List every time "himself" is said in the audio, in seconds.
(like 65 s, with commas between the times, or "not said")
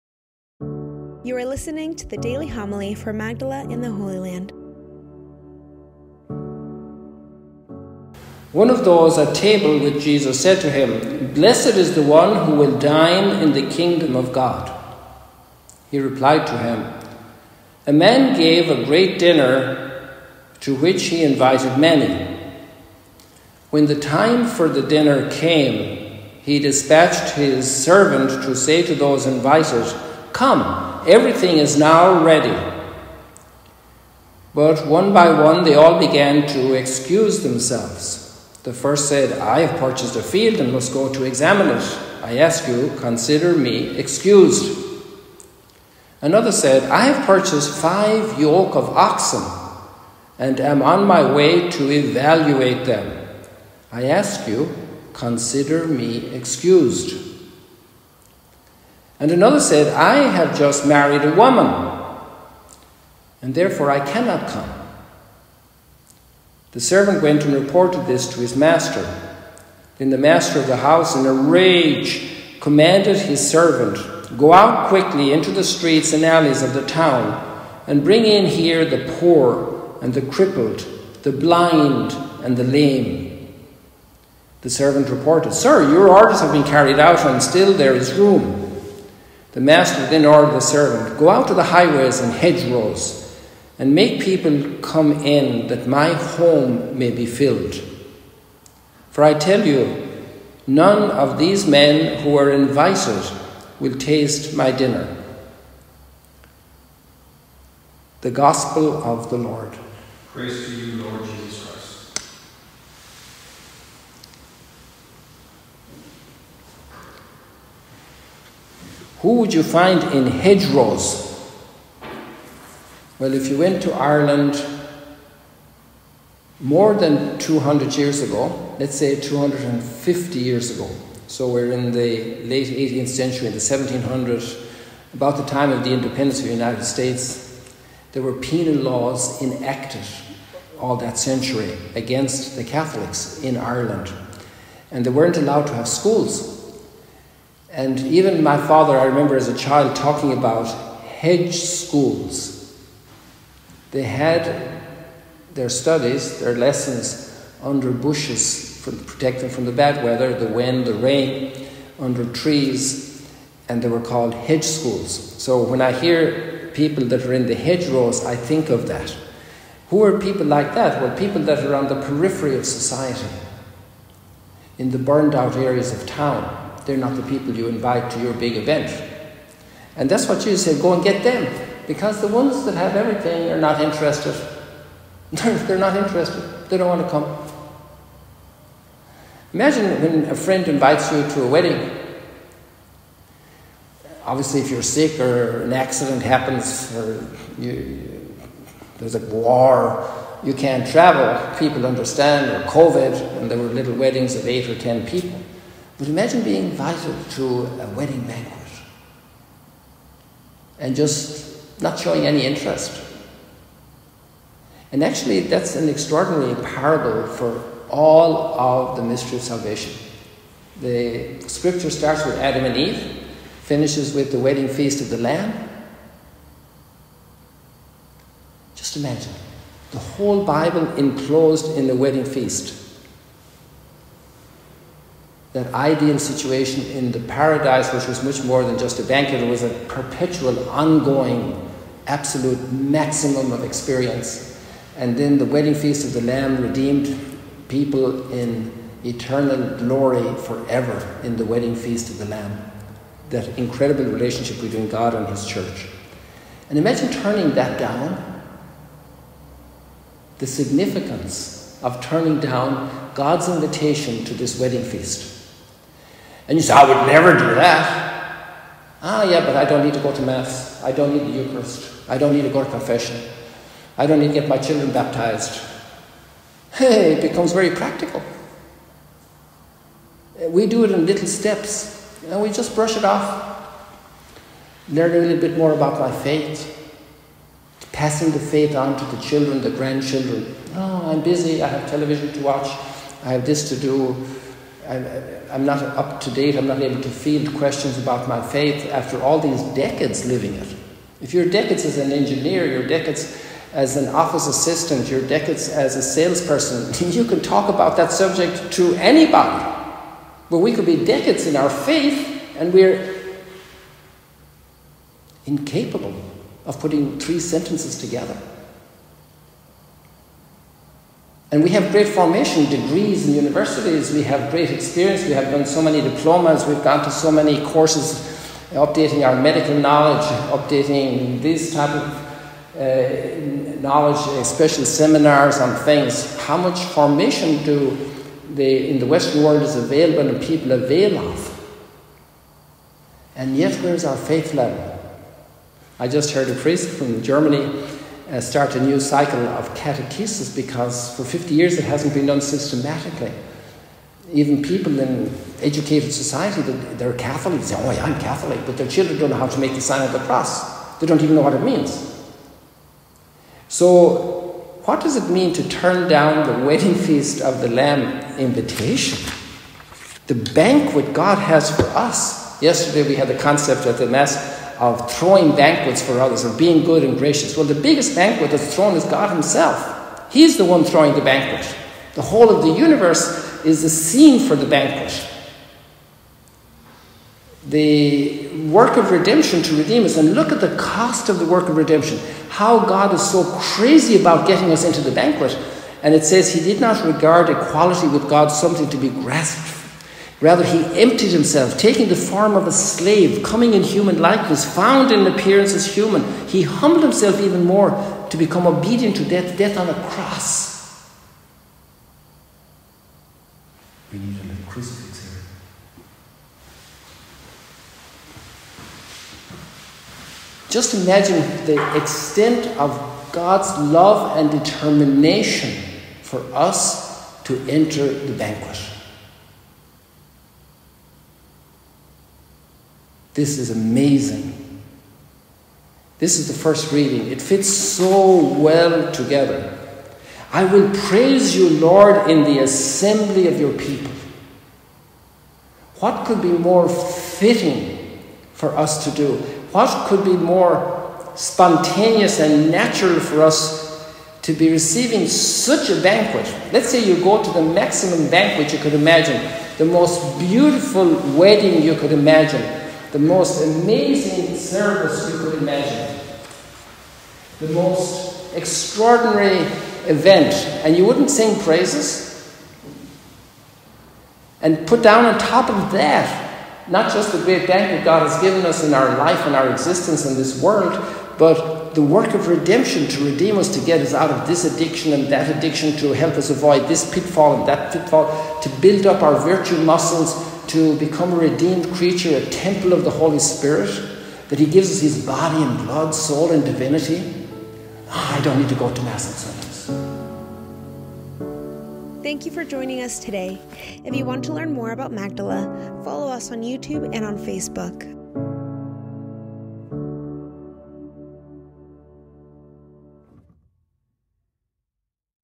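379 s, 401 s, 407 s.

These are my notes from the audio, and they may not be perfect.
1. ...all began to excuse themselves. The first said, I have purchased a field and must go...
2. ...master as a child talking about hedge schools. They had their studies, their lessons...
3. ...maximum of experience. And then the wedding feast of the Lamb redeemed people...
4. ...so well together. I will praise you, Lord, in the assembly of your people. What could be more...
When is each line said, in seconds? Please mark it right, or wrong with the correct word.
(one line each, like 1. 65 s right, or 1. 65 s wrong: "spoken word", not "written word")
1. 35 s right
2. 149 s wrong: "remember", not "master"
3. 242 s right
4. 437 s right.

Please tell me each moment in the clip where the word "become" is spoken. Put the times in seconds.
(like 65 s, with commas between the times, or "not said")
277 s, 408 s, 490 s.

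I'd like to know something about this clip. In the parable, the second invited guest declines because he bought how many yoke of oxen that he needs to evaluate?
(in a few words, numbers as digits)
5.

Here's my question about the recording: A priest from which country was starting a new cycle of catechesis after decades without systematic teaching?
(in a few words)
Germany.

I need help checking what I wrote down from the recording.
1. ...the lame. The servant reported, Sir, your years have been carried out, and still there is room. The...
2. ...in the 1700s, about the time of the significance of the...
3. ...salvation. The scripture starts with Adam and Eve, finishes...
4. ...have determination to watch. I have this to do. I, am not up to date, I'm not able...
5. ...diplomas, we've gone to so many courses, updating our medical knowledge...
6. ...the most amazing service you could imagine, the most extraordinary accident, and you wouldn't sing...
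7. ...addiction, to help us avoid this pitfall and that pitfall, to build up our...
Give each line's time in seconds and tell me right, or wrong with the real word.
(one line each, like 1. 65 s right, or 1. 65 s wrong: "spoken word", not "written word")
1. 82 s wrong: "orders", not "years"
2. 133 s wrong: "independence", not "significance"
3. 219 s right
4. 291 s wrong: "television", not "determination"
5. 325 s right
6. 463 s wrong: "event", not "accident"
7. 485 s right.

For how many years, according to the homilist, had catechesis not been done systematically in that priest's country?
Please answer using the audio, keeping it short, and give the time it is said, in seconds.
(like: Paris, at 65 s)
50, at 351 s.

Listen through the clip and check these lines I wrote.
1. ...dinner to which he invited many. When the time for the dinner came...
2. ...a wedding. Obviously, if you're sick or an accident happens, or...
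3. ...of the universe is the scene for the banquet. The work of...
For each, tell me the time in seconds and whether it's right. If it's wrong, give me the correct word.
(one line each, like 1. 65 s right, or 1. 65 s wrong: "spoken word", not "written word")
1. 19 s right
2. 191 s right
3. 382 s right.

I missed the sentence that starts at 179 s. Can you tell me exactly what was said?
And that's what Jesus said go and get them, because the ones that have everything are not interested.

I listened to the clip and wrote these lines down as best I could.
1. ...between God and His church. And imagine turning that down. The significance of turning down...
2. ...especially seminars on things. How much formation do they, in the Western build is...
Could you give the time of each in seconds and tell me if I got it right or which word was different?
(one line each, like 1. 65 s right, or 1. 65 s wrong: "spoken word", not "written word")
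1. 254 s right
2. 334 s wrong: "world", not "build".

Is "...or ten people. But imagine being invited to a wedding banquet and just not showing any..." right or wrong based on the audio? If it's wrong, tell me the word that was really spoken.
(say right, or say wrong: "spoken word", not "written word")
right.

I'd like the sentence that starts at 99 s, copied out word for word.
For I tell you, none of these men who are invited will taste my dinner.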